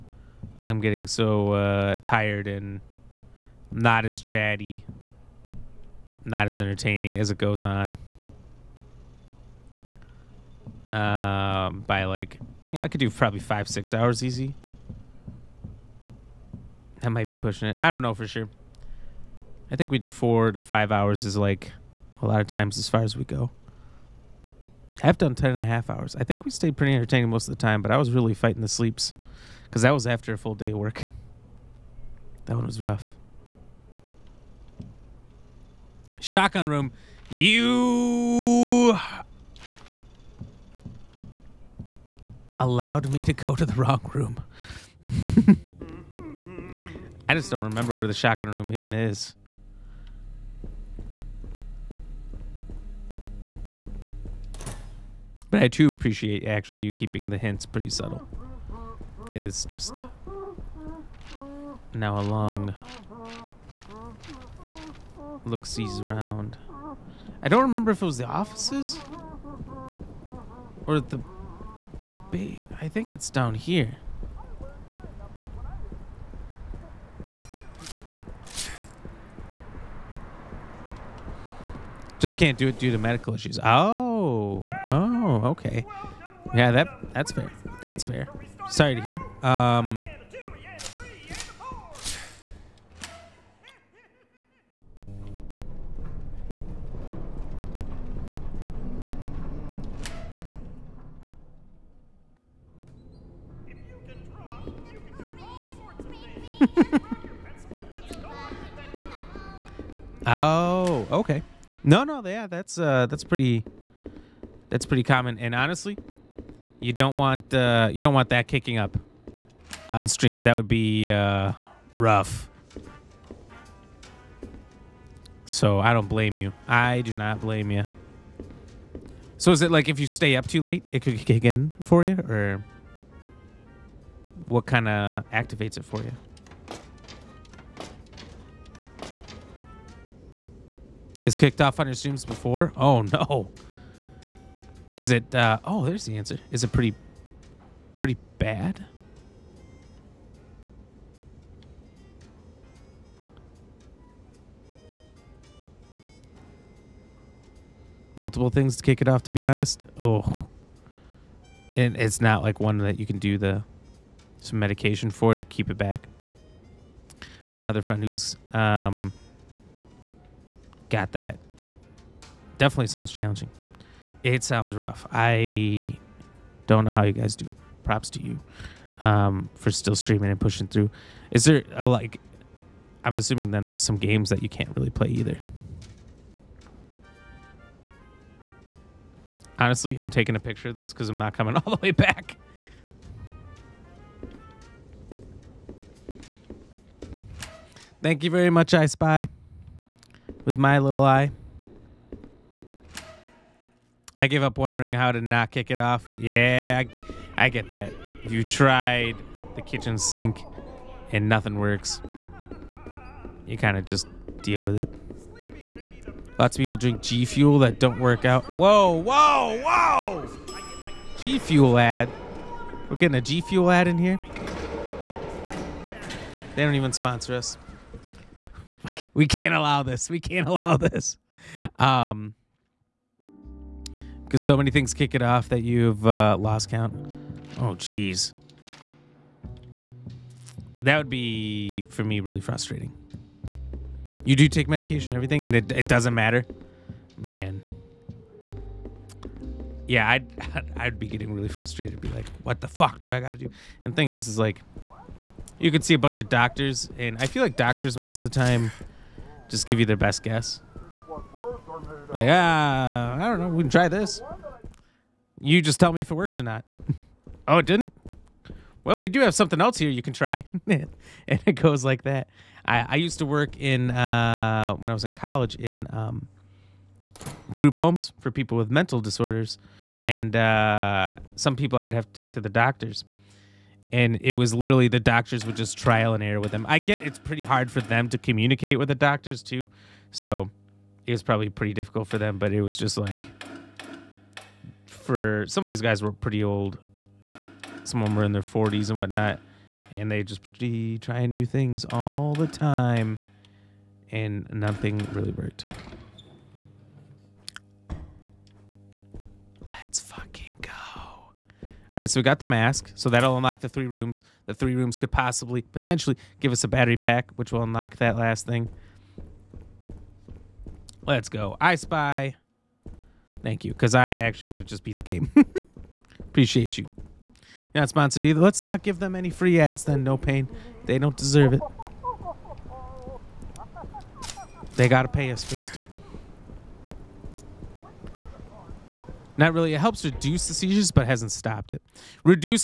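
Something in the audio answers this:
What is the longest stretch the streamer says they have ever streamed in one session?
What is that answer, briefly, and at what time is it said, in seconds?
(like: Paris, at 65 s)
10.5 hours, at 25 s.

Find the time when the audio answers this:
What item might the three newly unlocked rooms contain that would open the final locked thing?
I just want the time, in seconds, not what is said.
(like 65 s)
316 s.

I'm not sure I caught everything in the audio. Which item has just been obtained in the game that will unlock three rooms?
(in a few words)
The mask.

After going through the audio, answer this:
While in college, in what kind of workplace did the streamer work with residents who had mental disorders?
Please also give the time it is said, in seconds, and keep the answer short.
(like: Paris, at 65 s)
Group homes, at 277 s.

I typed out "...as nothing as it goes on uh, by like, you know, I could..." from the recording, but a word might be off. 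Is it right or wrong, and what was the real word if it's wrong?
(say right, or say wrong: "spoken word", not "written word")
wrong: "entertaining", not "nothing".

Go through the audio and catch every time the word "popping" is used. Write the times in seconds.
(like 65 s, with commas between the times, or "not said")
not said.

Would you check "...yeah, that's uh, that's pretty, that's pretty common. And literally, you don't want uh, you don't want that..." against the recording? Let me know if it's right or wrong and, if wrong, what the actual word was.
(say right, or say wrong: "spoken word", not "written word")
wrong: "honestly", not "literally".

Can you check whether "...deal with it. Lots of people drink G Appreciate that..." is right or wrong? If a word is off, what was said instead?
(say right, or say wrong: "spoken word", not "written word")
wrong: "Fuel", not "Appreciate".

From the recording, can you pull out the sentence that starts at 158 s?
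Multiple things to kick it off.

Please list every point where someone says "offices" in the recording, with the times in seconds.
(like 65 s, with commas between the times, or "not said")
68 s.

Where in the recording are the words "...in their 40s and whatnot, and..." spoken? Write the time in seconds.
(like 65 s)
298 s.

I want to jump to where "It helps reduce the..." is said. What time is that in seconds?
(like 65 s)
339 s.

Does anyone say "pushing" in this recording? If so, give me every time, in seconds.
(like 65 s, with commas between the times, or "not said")
17 s, 180 s.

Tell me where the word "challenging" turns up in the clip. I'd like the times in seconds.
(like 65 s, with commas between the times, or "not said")
173 s.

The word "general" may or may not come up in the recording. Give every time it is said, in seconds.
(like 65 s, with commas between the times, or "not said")
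not said.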